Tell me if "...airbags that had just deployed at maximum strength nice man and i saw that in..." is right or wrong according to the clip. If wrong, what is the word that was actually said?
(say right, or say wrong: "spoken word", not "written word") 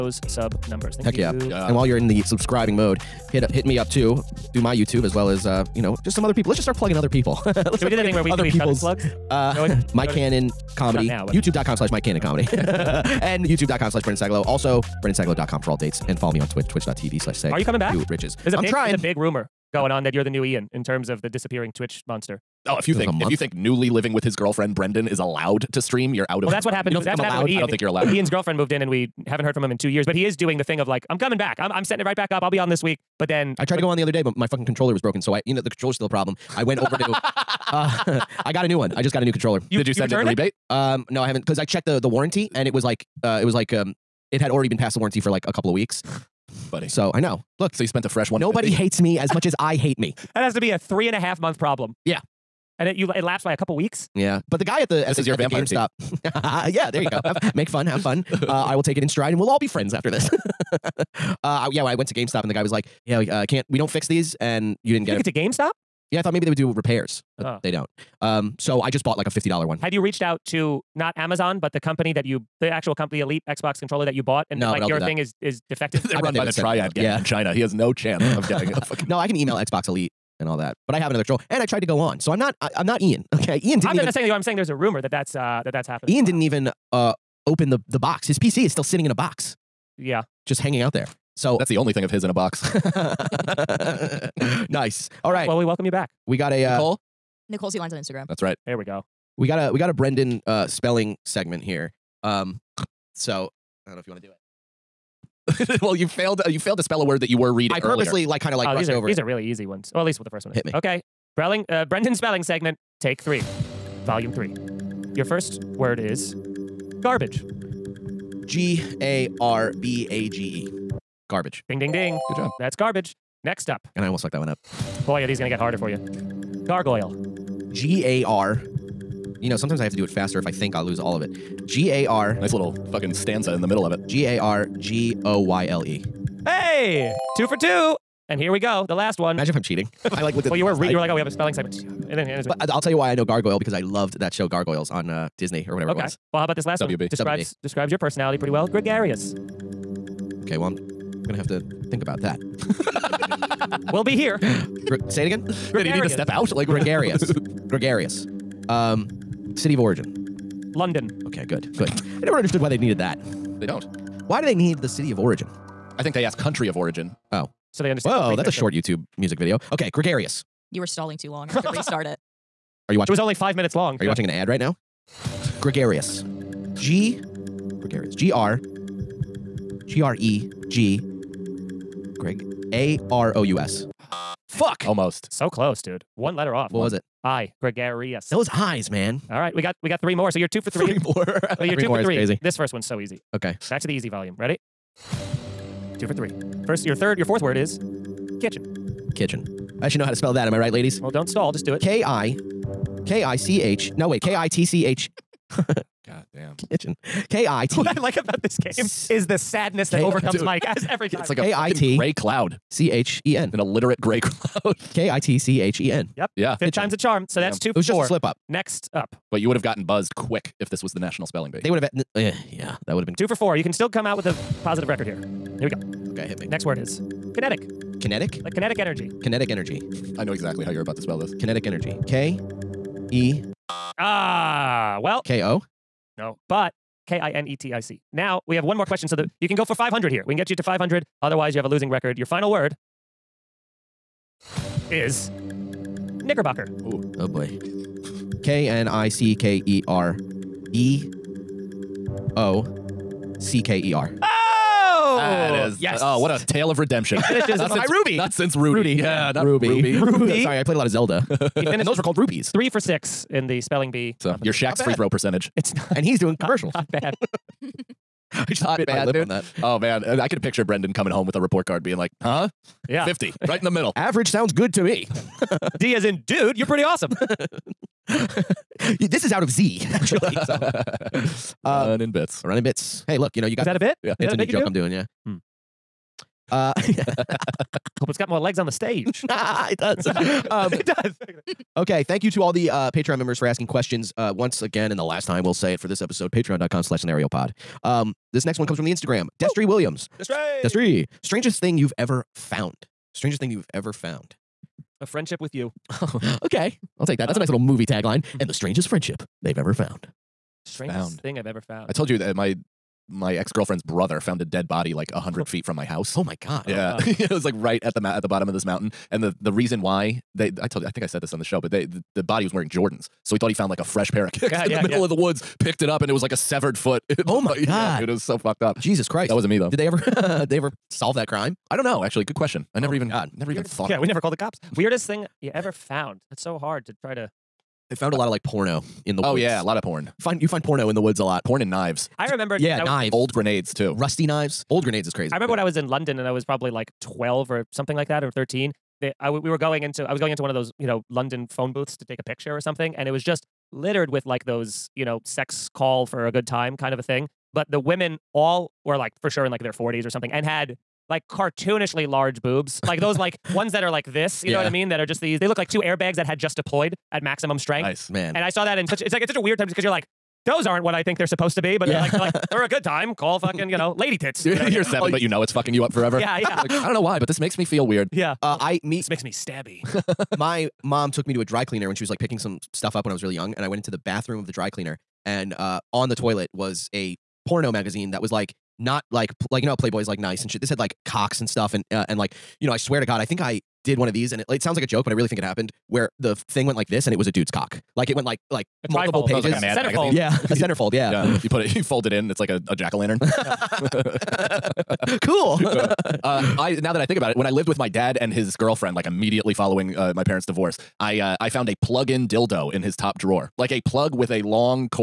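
right.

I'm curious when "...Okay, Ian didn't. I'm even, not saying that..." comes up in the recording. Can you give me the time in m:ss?
1:23.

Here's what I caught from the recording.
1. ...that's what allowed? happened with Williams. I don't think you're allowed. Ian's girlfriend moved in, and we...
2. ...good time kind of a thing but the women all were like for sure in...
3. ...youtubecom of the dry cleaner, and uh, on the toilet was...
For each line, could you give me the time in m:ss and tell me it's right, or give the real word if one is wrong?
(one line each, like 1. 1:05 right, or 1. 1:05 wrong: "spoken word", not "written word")
1. 0:27 wrong: "Ian", not "Williams"
2. 5:56 right
3. 6:23 wrong: "bathroom", not "youtubecom".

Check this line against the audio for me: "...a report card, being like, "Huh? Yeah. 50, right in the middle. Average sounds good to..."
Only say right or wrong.
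right.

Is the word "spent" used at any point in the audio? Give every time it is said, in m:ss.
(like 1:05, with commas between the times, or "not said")
0:47.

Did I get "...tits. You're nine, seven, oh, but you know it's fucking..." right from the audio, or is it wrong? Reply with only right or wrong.
wrong.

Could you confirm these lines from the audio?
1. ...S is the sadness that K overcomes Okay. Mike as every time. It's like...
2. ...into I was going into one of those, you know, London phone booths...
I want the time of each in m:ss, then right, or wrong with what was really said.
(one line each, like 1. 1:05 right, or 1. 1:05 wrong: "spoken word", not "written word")
1. 3:28 wrong: "Dude", not "Okay"
2. 5:49 right.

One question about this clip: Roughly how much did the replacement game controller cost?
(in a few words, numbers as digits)
$50.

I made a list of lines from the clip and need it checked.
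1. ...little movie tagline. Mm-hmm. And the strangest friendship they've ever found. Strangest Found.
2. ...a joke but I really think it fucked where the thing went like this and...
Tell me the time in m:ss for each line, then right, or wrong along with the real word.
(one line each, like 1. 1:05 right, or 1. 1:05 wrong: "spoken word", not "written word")
1. 5:07 right
2. 6:34 wrong: "happened", not "fucked".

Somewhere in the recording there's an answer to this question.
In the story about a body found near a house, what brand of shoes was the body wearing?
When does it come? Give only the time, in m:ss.
5:22.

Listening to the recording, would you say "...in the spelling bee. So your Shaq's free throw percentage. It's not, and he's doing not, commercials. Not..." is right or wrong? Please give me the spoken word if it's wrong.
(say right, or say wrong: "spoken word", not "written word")
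right.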